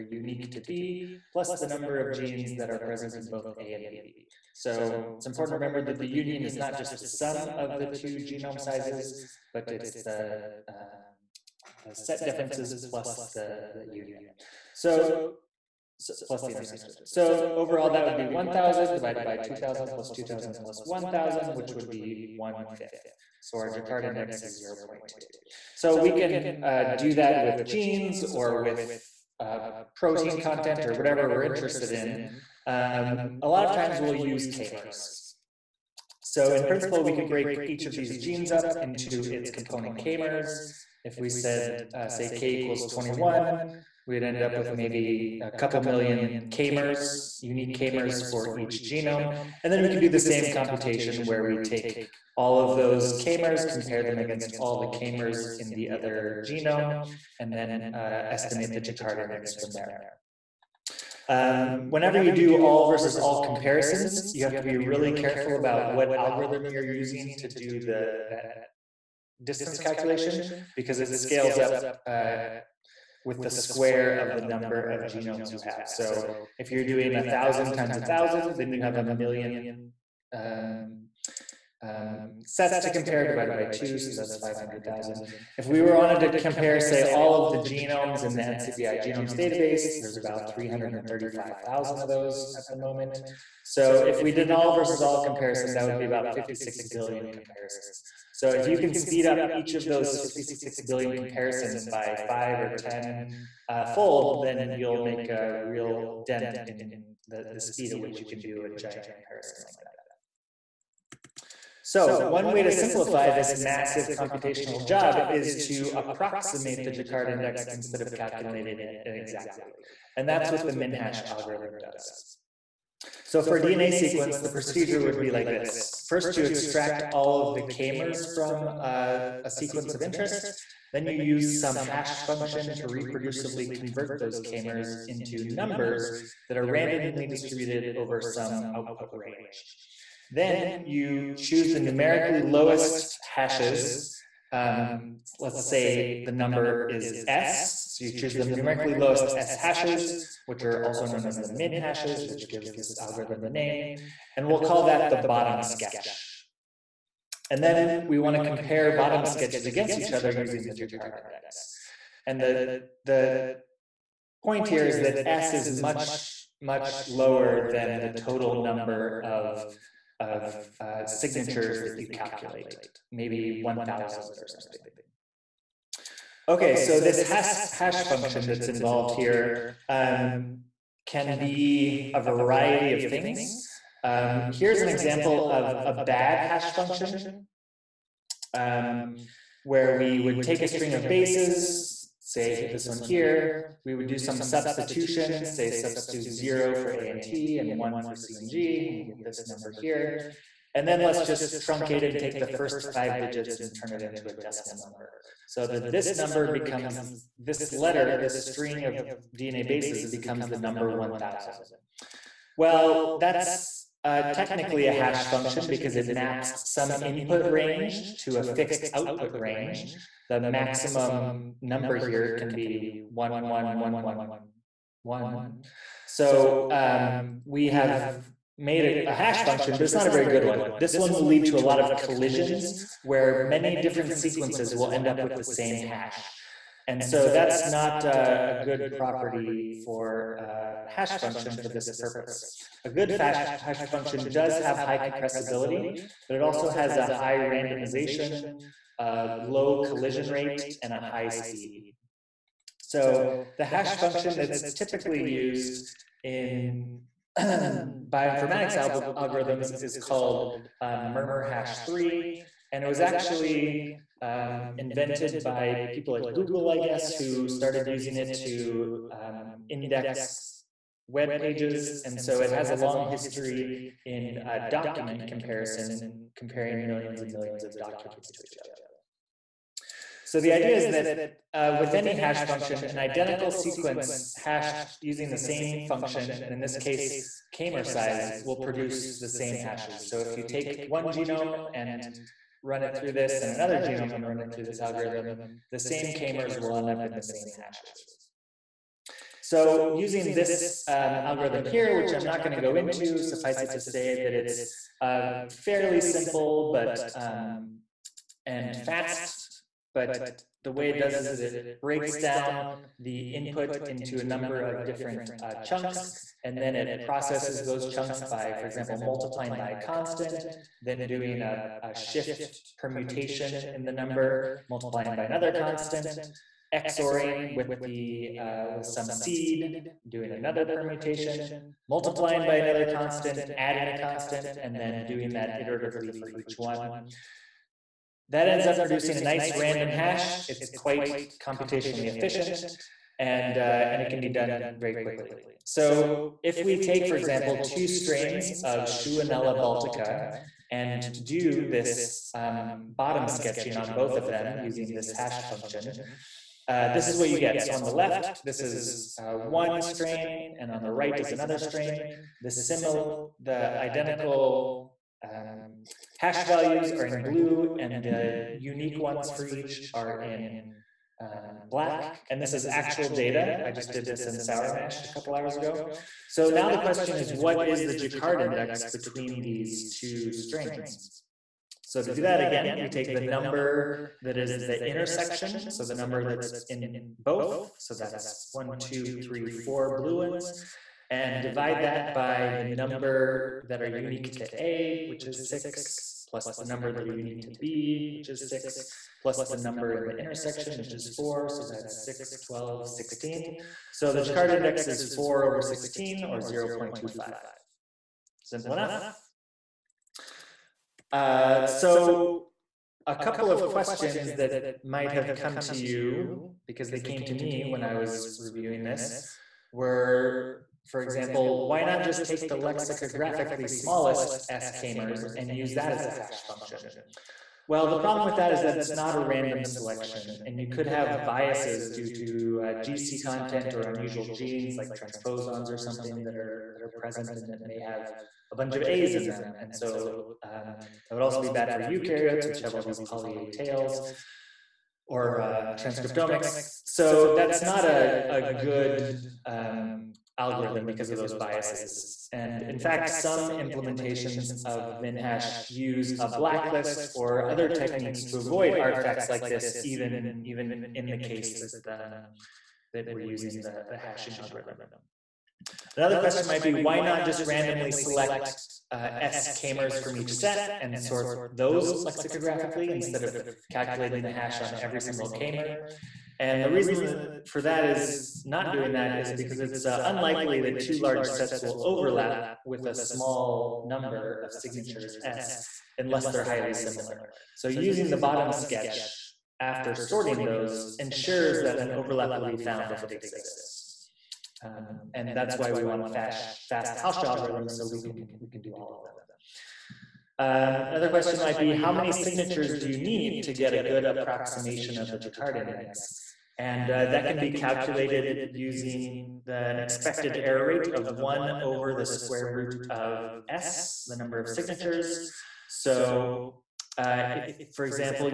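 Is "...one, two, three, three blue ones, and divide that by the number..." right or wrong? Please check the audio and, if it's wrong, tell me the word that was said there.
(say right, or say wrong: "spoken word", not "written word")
wrong: "four", not "three".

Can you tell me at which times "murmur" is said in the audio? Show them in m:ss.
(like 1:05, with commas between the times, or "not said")
4:21.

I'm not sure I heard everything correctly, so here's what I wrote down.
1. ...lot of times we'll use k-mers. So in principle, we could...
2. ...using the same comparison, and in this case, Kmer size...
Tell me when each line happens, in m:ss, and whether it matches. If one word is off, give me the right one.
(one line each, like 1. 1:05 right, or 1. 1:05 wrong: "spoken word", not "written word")
1. 0:33 right
2. 4:45 wrong: "function", not "comparison".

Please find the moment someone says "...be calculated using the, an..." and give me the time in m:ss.
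8:27.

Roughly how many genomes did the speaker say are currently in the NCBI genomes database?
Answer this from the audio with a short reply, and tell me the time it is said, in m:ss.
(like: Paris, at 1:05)
335,000, at 1:30.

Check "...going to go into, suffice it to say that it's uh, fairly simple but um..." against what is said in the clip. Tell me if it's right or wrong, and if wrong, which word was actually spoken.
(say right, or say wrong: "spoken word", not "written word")
right.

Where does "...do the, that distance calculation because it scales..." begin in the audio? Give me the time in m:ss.
1:07.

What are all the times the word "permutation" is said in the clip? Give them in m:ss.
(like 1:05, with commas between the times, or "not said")
5:22, 5:30.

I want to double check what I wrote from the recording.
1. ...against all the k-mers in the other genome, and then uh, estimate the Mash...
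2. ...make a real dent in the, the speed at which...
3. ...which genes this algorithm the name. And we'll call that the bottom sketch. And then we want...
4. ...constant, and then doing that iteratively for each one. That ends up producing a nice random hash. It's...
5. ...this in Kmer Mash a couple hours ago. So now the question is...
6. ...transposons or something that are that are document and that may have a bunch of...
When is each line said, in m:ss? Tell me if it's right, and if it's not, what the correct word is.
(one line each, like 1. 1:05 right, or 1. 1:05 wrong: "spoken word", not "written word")
1. 0:54 wrong: "Jaccard", not "Mash"
2. 1:44 right
3. 2:32 wrong: "gives", not "genes"
4. 5:33 right
5. 6:14 wrong: "Sour", not "Kmer"
6. 7:15 wrong: "present", not "document".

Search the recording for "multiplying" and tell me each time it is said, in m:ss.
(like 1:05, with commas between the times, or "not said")
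5:19, 5:24, 5:31.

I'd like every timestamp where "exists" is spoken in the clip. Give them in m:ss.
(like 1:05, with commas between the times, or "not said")
8:13.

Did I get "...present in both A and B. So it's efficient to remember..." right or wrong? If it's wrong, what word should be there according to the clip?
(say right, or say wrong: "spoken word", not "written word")
wrong: "important", not "efficient".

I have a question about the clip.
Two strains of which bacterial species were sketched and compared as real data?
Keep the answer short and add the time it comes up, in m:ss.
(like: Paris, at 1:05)
Shewanella baltica, at 5:48.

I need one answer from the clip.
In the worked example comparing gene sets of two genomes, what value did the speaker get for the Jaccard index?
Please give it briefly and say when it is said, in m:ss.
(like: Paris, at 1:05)
0.2, at 0:24.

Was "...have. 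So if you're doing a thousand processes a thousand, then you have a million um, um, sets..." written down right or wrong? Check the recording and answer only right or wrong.
wrong.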